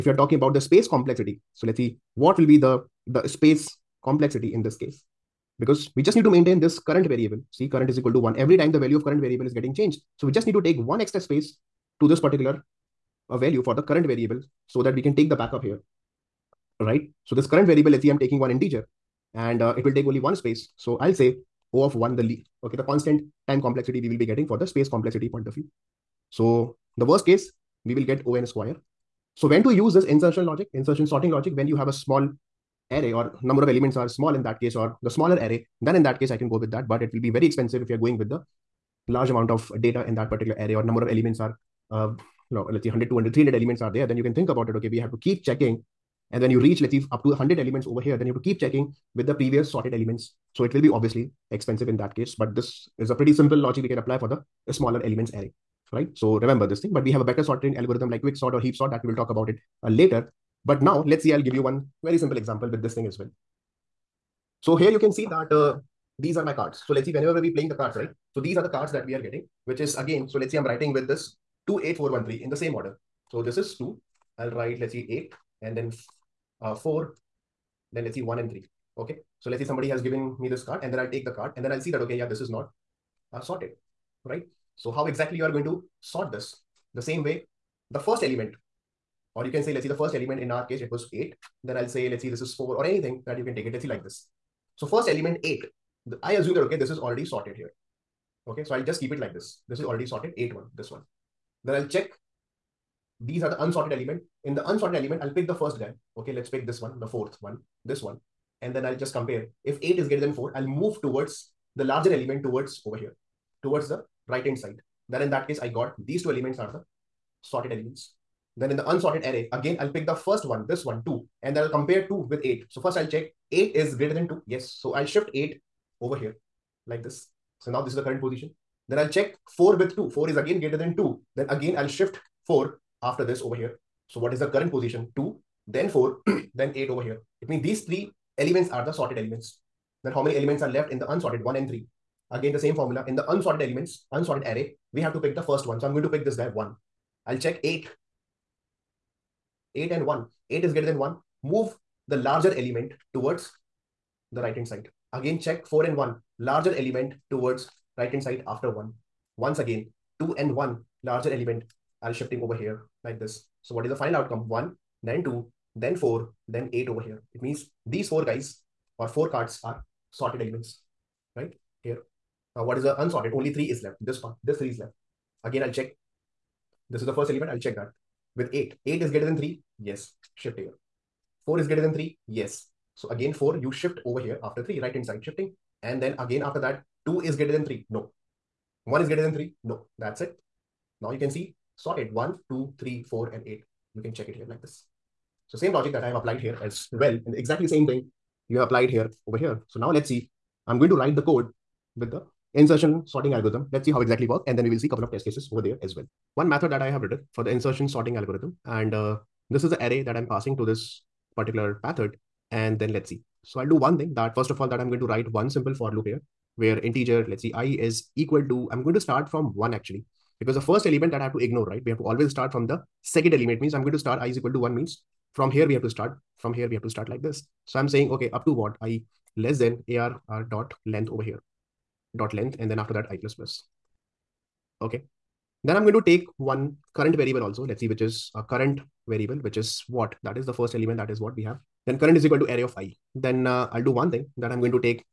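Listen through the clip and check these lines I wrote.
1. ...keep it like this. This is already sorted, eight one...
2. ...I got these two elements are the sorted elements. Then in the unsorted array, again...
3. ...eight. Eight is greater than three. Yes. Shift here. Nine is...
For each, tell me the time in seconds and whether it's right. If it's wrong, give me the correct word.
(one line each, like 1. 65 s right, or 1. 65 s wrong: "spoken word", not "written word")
1. 99 s right
2. 115 s right
3. 178 s wrong: "Four", not "Nine".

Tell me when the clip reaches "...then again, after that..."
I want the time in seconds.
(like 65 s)
185 s.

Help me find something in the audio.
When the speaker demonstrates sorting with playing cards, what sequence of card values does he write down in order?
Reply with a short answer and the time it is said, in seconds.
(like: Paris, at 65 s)
28413, at 71 s.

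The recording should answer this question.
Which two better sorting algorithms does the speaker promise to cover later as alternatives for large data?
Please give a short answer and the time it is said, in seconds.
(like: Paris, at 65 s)
quicksort or heap sort, at 58 s.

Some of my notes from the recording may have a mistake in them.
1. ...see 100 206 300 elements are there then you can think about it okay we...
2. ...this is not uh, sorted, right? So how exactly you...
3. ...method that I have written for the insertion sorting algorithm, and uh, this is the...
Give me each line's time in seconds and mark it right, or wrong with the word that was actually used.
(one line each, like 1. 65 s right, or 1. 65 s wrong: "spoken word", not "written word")
1. 42 s wrong: "200", not "206"
2. 82 s right
3. 206 s right.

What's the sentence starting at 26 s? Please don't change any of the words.
So the worst case, we will get O_n square.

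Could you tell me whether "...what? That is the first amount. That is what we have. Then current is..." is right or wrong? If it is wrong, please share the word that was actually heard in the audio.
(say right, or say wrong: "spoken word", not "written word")
wrong: "element", not "amount".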